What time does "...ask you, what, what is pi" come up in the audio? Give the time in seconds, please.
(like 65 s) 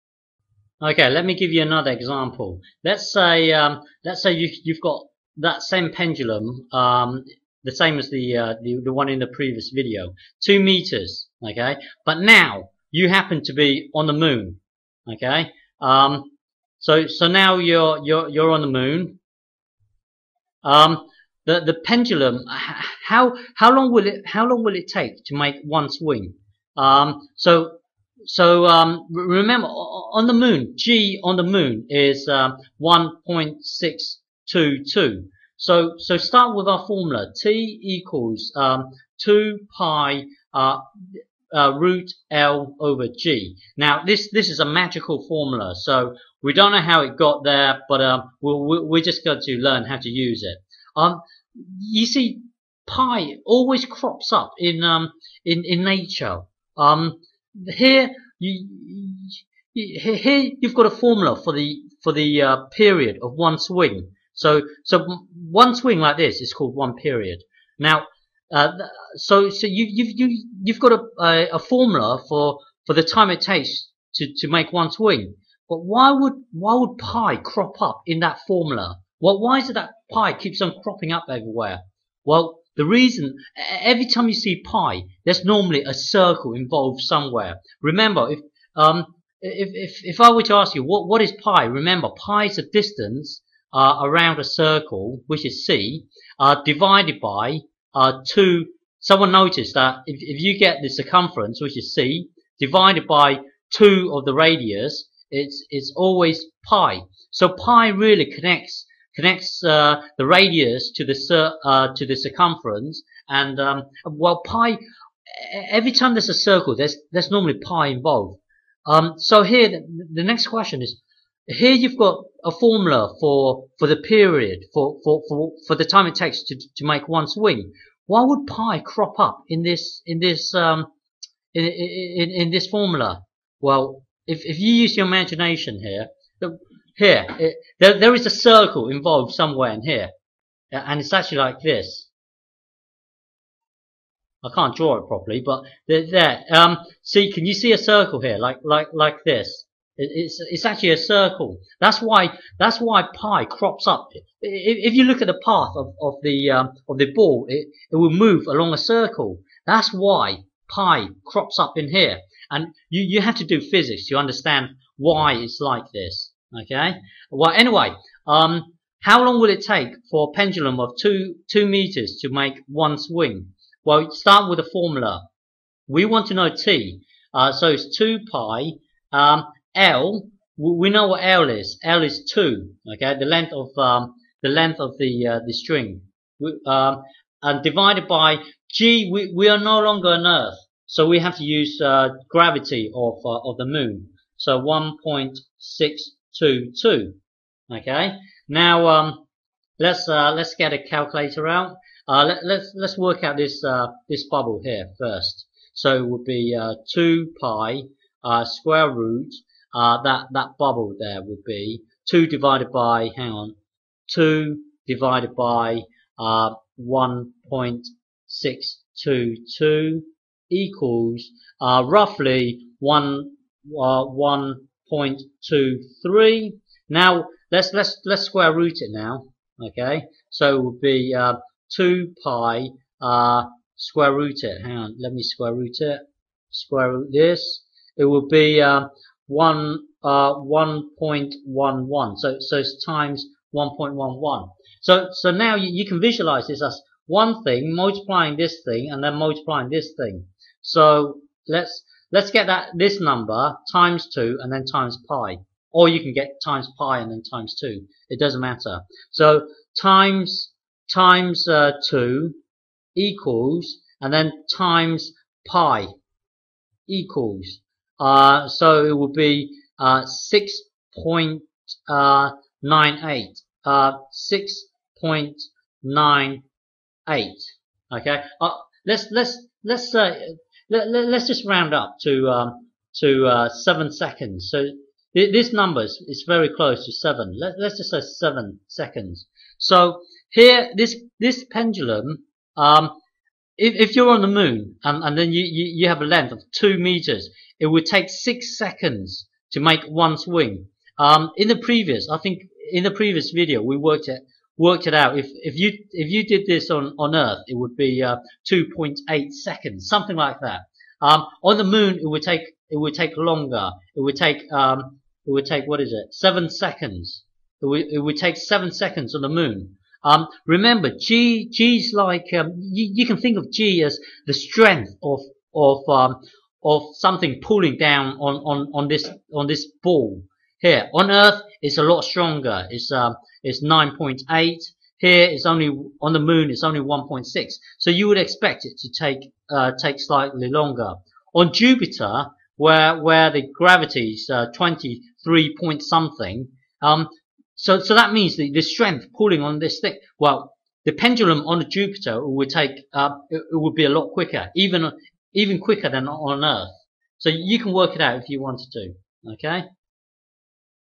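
90 s.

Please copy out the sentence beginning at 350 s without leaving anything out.
Well, the pendulum on Jupiter would take uh, it, it would be a lot quicker, even even quicker than on Earth.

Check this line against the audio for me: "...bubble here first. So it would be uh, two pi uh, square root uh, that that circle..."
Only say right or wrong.
wrong.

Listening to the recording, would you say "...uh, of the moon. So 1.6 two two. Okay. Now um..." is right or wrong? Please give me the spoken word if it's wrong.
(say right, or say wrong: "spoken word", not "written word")
right.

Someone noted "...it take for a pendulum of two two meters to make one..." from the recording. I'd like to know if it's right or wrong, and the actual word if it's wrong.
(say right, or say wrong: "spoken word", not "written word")
right.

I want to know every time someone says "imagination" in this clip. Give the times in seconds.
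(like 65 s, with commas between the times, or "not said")
135 s.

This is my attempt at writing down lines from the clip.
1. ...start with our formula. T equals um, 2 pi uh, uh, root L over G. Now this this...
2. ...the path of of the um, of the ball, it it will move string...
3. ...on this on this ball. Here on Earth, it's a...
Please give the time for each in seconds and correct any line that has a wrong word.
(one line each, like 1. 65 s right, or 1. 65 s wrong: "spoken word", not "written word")
1. 36 s right
2. 155 s wrong: "along", not "string"
3. 328 s right.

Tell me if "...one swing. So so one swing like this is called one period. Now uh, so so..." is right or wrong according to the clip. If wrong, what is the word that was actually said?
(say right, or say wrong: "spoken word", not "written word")
right.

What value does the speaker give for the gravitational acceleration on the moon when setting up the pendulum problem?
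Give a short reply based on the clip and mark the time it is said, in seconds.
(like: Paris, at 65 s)
1.622, at 32 s.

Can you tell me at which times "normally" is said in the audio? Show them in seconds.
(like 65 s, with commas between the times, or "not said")
85 s, 117 s.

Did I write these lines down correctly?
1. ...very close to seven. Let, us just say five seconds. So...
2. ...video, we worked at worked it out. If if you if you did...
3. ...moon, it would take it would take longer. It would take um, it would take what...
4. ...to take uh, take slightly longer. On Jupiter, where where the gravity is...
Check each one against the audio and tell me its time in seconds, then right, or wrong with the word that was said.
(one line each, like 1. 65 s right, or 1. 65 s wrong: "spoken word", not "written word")
1. 286 s wrong: "seven", not "five"
2. 303 s right
3. 311 s right
4. 338 s right.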